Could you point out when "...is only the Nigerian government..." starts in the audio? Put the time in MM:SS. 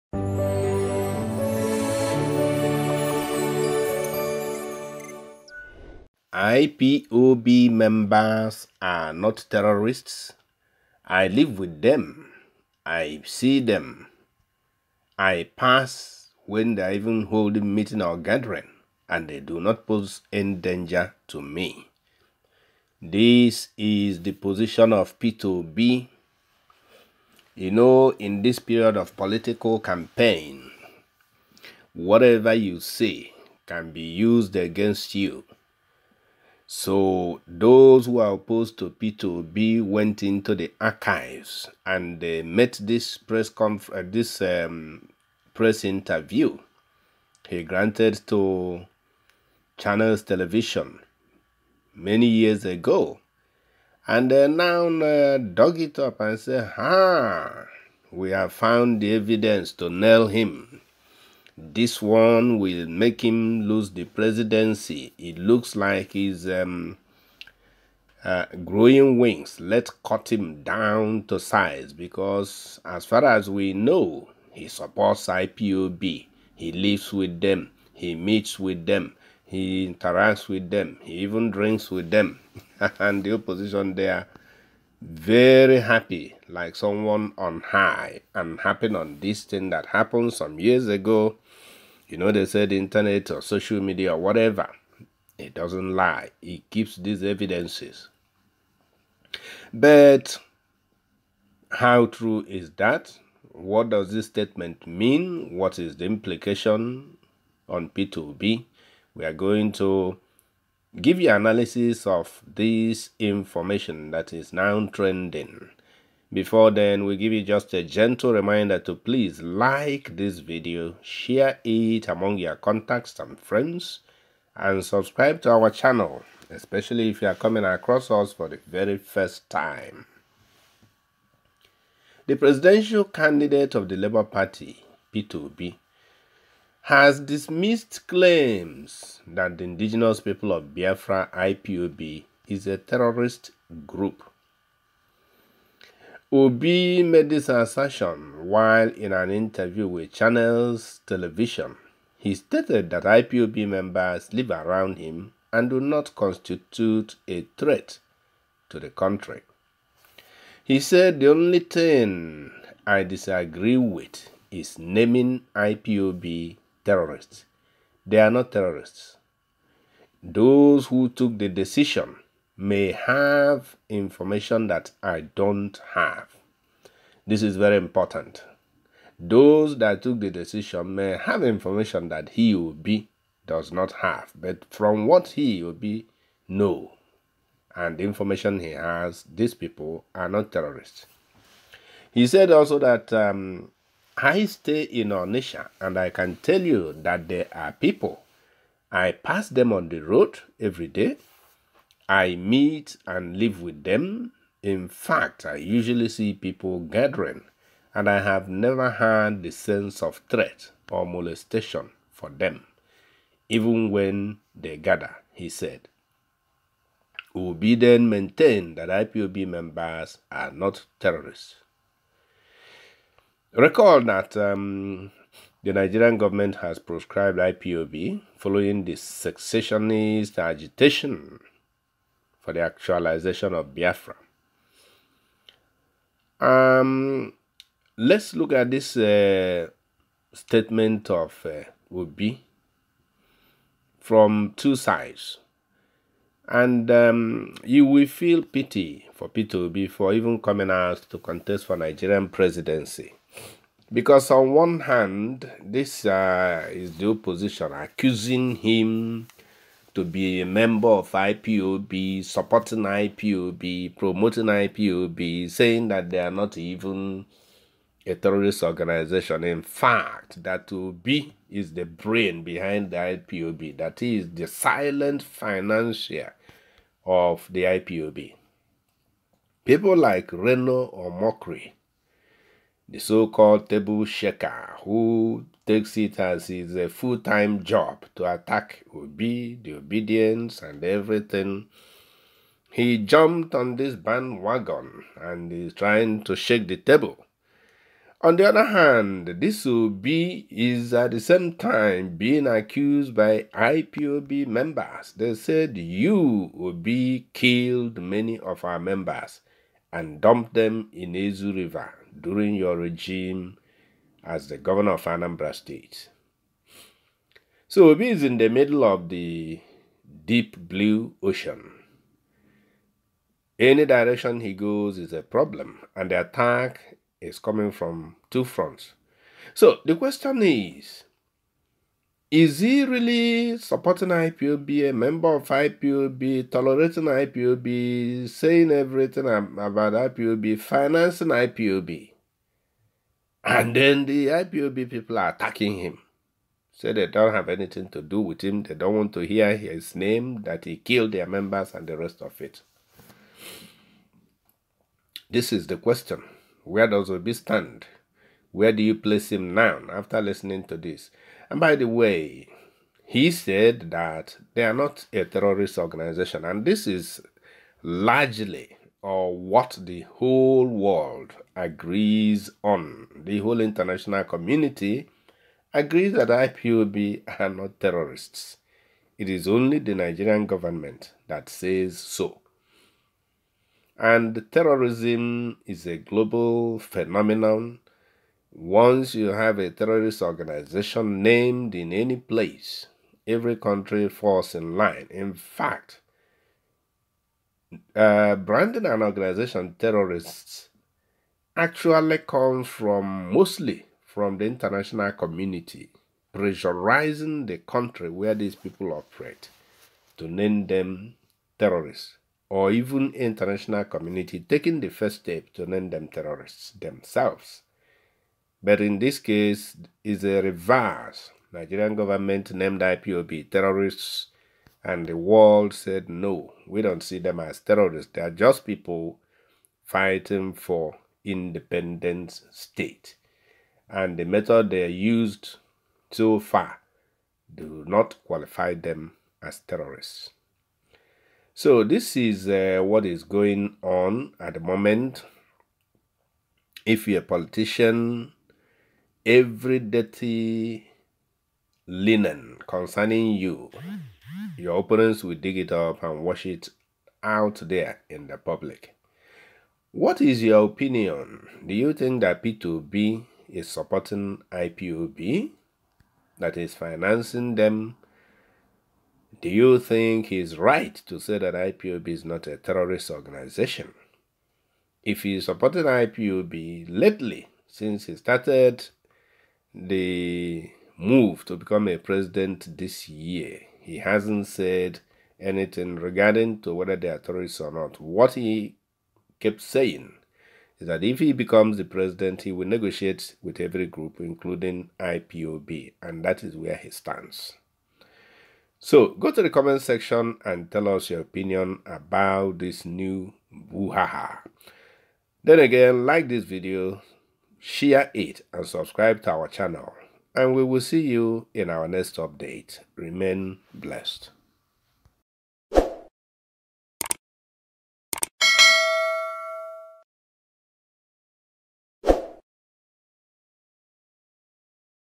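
06:19.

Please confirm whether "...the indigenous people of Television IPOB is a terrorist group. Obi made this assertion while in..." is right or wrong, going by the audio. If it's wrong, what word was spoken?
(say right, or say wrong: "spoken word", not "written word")
wrong: "Biafra", not "Television".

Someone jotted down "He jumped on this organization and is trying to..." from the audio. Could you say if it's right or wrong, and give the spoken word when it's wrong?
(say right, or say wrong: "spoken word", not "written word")
wrong: "bandwagon", not "organization".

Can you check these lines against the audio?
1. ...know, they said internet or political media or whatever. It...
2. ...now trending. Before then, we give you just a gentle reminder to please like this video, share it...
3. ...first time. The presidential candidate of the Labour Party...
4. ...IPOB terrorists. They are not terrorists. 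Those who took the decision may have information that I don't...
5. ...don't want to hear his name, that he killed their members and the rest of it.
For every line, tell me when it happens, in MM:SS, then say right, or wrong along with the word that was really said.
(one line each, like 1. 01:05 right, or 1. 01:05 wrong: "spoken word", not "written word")
1. 01:32 wrong: "social", not "political"
2. 01:54 right
3. 02:08 right
4. 02:45 right
5. 05:48 right.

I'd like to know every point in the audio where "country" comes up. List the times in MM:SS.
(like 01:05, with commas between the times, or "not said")
02:38, 06:33, 06:47.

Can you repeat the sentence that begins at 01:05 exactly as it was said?
It looks like he's um, uh, growing wings.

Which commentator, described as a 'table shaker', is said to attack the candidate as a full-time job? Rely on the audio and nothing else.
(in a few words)
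Reno Omokri.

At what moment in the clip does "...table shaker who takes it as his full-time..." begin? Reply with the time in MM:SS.
04:43.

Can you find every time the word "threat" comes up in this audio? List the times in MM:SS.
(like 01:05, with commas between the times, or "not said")
02:37, 03:30.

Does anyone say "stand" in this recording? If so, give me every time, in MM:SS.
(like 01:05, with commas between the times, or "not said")
05:57, 08:16.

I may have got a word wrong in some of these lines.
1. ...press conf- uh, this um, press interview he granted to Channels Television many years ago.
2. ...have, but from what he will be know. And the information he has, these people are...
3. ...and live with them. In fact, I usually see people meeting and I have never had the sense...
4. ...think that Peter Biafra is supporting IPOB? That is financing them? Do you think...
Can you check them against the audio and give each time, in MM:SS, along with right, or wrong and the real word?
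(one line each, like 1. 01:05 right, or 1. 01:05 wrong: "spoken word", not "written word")
1. 00:43 right
2. 03:04 right
3. 03:23 wrong: "gathering", not "meeting"
4. 07:41 wrong: "Obi", not "Biafra".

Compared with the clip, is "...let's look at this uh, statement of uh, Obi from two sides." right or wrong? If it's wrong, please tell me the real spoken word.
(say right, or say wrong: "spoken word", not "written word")
right.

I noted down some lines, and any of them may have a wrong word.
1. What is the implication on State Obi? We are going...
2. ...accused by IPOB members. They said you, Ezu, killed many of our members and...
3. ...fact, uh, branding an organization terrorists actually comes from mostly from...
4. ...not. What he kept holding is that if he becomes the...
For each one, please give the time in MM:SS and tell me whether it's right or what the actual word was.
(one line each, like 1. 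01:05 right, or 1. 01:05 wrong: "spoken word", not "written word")
1. 01:45 wrong: "Peter", not "State"
2. 05:02 wrong: "Obi", not "Ezu"
3. 06:35 right
4. 08:07 wrong: "saying", not "holding".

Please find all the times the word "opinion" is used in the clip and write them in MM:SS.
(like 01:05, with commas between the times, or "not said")
07:40, 08:21.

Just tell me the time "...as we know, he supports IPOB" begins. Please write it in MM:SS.
01:13.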